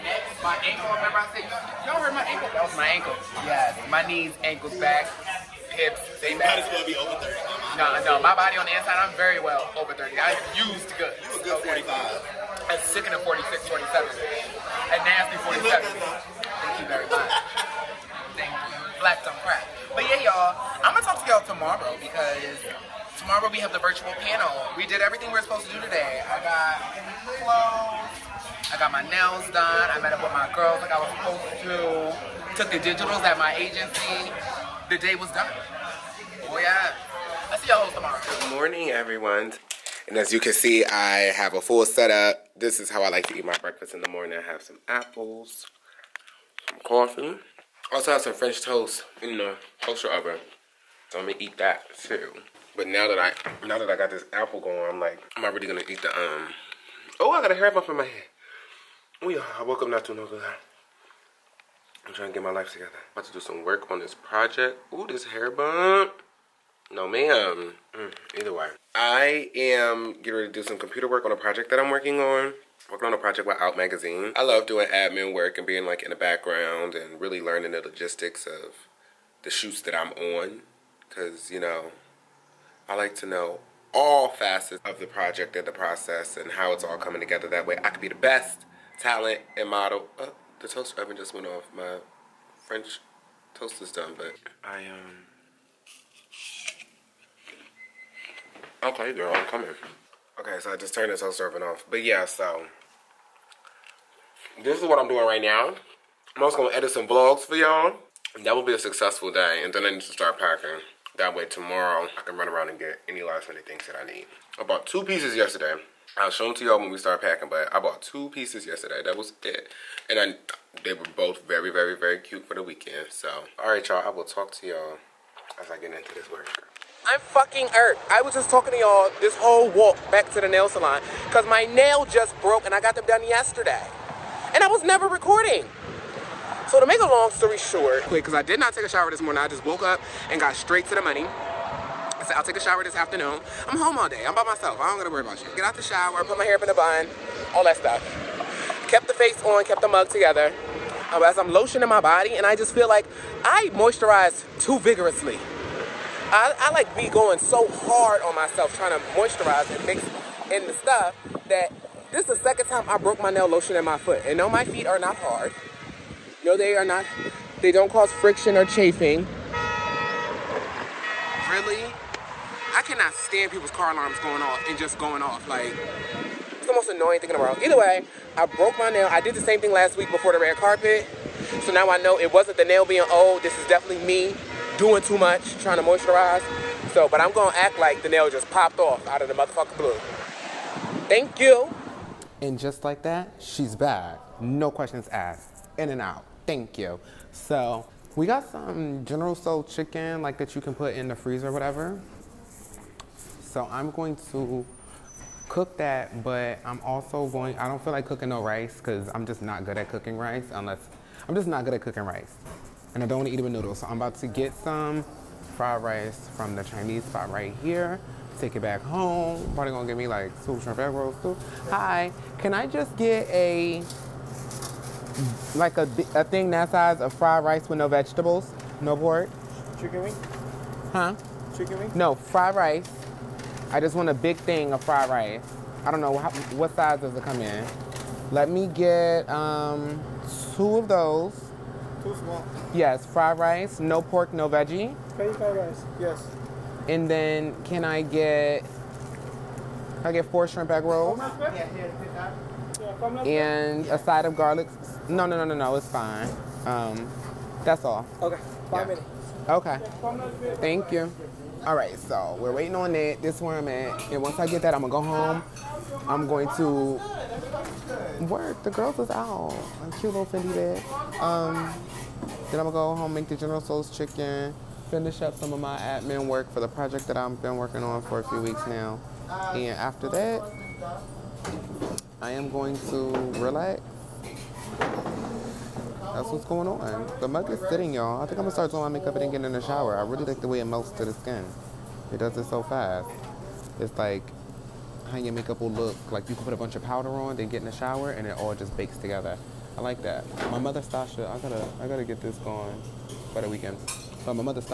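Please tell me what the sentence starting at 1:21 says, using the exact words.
Cause you know, I like to know all facets of the project and the process and how it's all coming together.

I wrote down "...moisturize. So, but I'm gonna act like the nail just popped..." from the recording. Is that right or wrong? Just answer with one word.
right.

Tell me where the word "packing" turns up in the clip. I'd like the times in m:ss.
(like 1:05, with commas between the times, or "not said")
1:50, 1:57.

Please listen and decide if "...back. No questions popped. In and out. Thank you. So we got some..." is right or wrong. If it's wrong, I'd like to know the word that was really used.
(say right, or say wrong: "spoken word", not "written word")
wrong: "asked", not "popped".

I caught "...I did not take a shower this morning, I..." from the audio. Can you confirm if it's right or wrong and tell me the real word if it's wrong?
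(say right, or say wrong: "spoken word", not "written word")
right.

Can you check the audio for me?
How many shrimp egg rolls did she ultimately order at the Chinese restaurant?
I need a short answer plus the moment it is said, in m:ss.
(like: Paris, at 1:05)
4, at 4:10.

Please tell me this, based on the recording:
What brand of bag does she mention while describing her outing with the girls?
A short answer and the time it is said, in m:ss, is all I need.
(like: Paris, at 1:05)
Fendi, at 4:30.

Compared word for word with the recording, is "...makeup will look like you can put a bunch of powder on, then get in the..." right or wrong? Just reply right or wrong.
right.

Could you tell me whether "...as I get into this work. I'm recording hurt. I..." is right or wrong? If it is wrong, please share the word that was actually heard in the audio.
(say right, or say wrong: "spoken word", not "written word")
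wrong: "fucking", not "recording".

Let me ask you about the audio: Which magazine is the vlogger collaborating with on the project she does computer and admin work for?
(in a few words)
Out Magazine.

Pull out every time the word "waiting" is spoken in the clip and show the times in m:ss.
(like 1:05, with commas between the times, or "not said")
4:22.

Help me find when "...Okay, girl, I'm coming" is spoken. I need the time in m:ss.
1:38.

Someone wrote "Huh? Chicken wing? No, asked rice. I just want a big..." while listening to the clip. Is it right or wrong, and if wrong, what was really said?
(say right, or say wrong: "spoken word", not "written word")
wrong: "fried", not "asked".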